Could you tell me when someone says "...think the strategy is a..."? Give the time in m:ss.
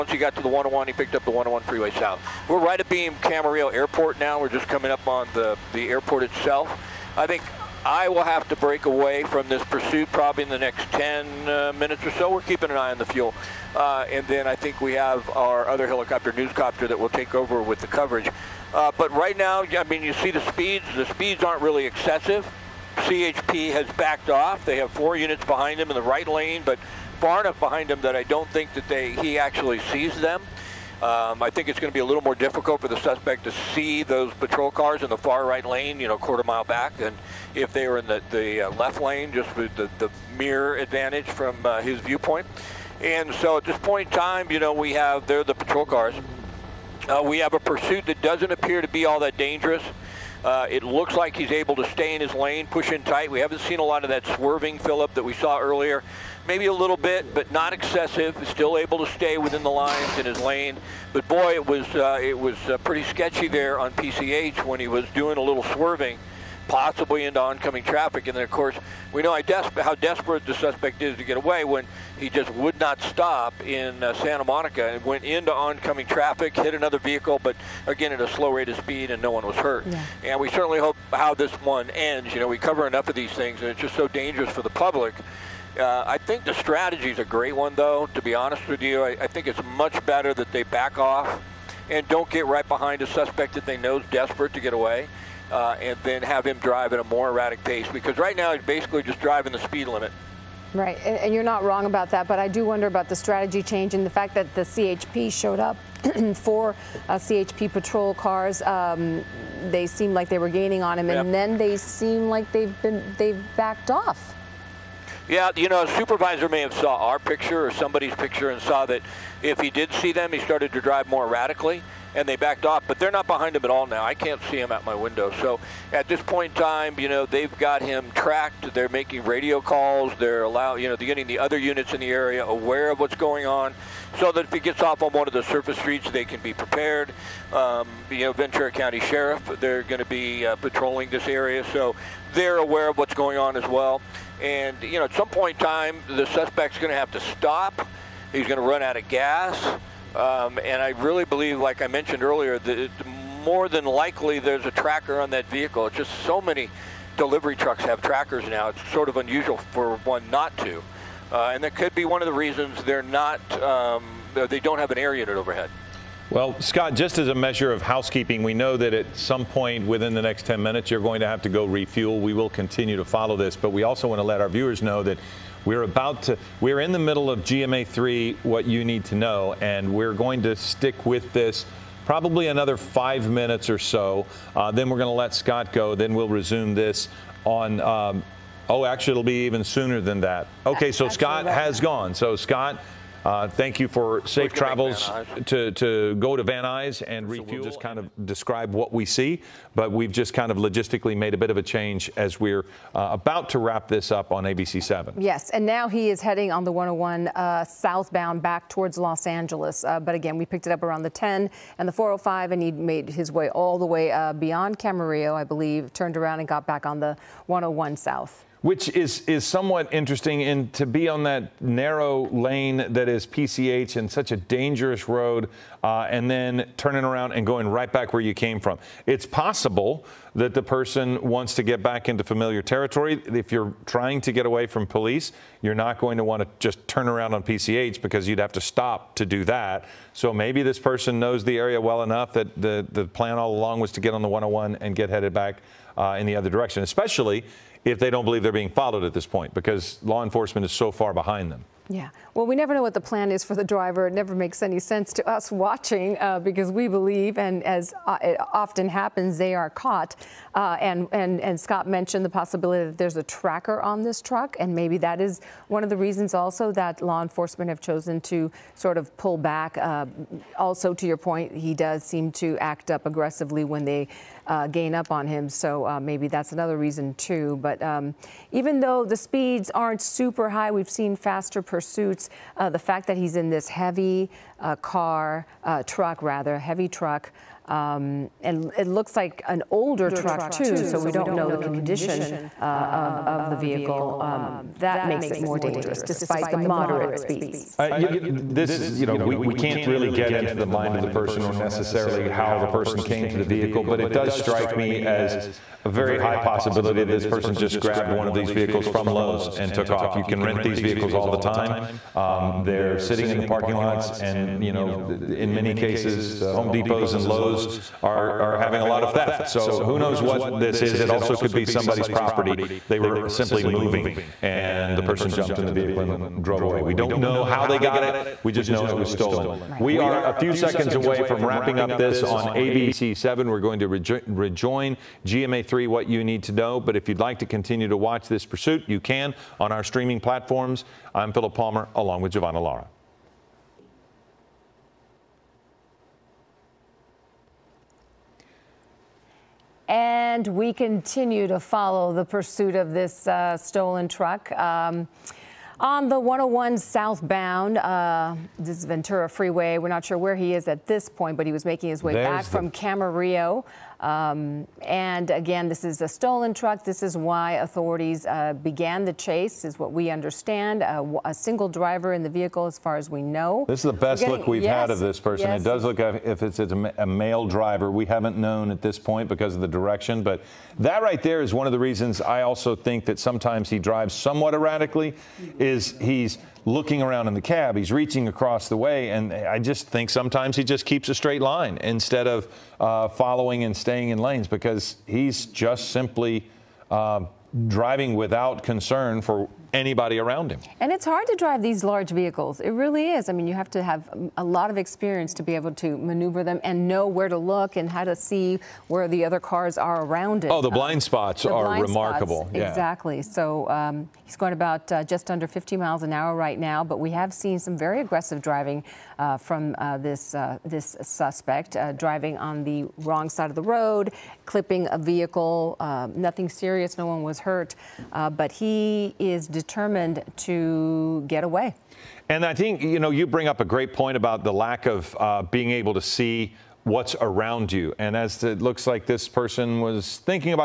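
1:26.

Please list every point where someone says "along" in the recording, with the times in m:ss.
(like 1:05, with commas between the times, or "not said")
4:03, 5:41.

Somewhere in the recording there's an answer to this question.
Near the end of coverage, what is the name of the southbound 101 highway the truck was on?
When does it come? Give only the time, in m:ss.
5:58.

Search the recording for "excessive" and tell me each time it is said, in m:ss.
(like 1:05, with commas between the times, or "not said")
0:21, 0:57.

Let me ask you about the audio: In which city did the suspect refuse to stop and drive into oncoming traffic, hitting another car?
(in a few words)
Santa Monica.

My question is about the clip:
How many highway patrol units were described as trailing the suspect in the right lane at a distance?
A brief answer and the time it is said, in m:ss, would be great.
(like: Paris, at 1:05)
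4, at 0:24.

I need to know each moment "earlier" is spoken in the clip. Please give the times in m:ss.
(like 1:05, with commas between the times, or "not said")
0:55, 2:32.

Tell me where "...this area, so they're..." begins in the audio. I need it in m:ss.
2:21.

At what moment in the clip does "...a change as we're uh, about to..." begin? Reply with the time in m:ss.
3:21.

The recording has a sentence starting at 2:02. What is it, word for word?
But they're not behind him at all now.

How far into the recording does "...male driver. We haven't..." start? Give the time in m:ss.
6:17.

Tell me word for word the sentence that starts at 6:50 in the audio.
Oh, the uh, blind um, spots the are blind remarkable.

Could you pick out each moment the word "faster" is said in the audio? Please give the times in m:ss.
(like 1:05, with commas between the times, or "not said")
4:41.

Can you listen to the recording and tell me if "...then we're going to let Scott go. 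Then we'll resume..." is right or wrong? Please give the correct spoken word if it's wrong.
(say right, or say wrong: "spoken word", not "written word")
right.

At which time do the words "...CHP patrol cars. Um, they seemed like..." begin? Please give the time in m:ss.
1:47.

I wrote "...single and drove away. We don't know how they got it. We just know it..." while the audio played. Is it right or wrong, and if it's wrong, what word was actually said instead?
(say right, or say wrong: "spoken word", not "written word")
wrong: "vehicle", not "single".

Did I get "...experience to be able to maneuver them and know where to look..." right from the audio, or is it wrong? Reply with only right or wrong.
right.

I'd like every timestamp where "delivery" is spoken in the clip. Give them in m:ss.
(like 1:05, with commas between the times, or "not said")
2:37.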